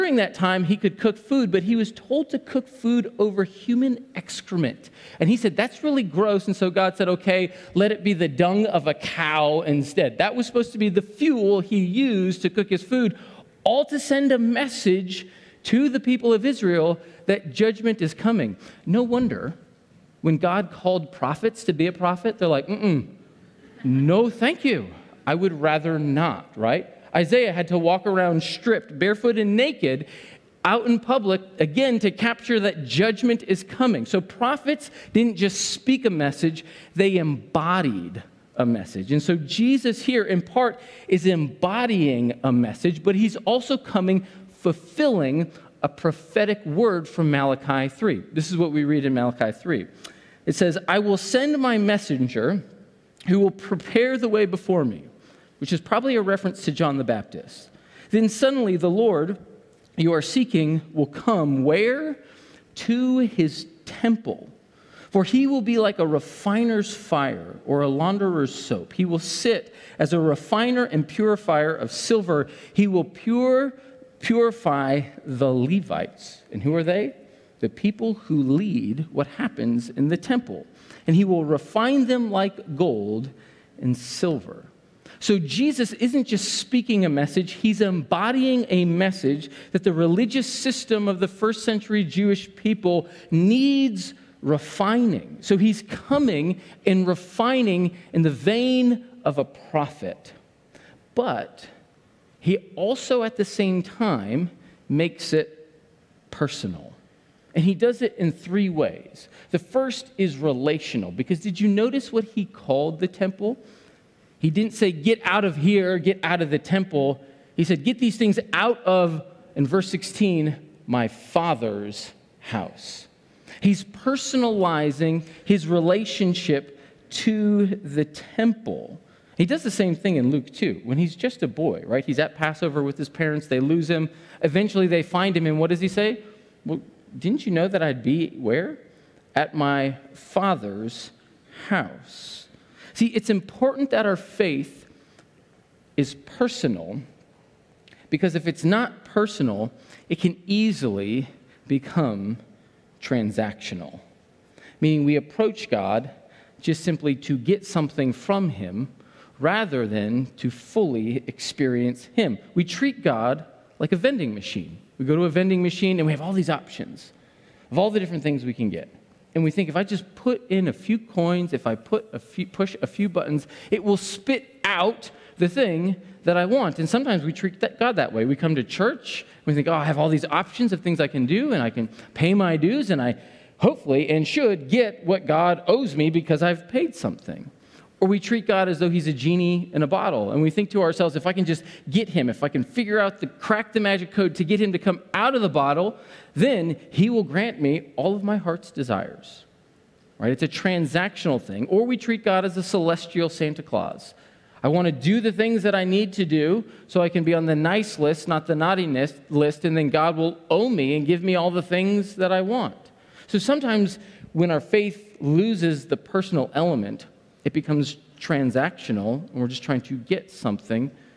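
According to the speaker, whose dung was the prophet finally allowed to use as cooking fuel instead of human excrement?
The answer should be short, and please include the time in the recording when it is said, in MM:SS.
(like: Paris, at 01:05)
A cow, at 00:08.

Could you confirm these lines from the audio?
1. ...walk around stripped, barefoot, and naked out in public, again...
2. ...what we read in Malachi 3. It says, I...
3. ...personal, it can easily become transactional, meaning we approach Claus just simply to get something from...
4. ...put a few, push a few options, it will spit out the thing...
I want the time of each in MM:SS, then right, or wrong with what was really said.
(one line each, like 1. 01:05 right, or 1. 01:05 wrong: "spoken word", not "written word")
1. 00:27 right
2. 00:48 right
3. 02:29 wrong: "God", not "Claus"
4. 02:51 wrong: "buttons", not "options".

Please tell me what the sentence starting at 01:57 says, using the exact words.
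He said, Get these things out of, in verse 16, my father's house.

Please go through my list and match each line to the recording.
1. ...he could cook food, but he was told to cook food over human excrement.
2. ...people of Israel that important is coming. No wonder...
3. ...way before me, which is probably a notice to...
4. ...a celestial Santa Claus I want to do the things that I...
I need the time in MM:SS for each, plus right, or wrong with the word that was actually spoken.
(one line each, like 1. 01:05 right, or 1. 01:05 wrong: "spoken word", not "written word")
1. 00:00 right
2. 00:16 wrong: "judgment", not "important"
3. 00:54 wrong: "reference", not "notice"
4. 03:22 right.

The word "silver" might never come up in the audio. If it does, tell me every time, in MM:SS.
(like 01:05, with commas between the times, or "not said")
01:11, 01:23.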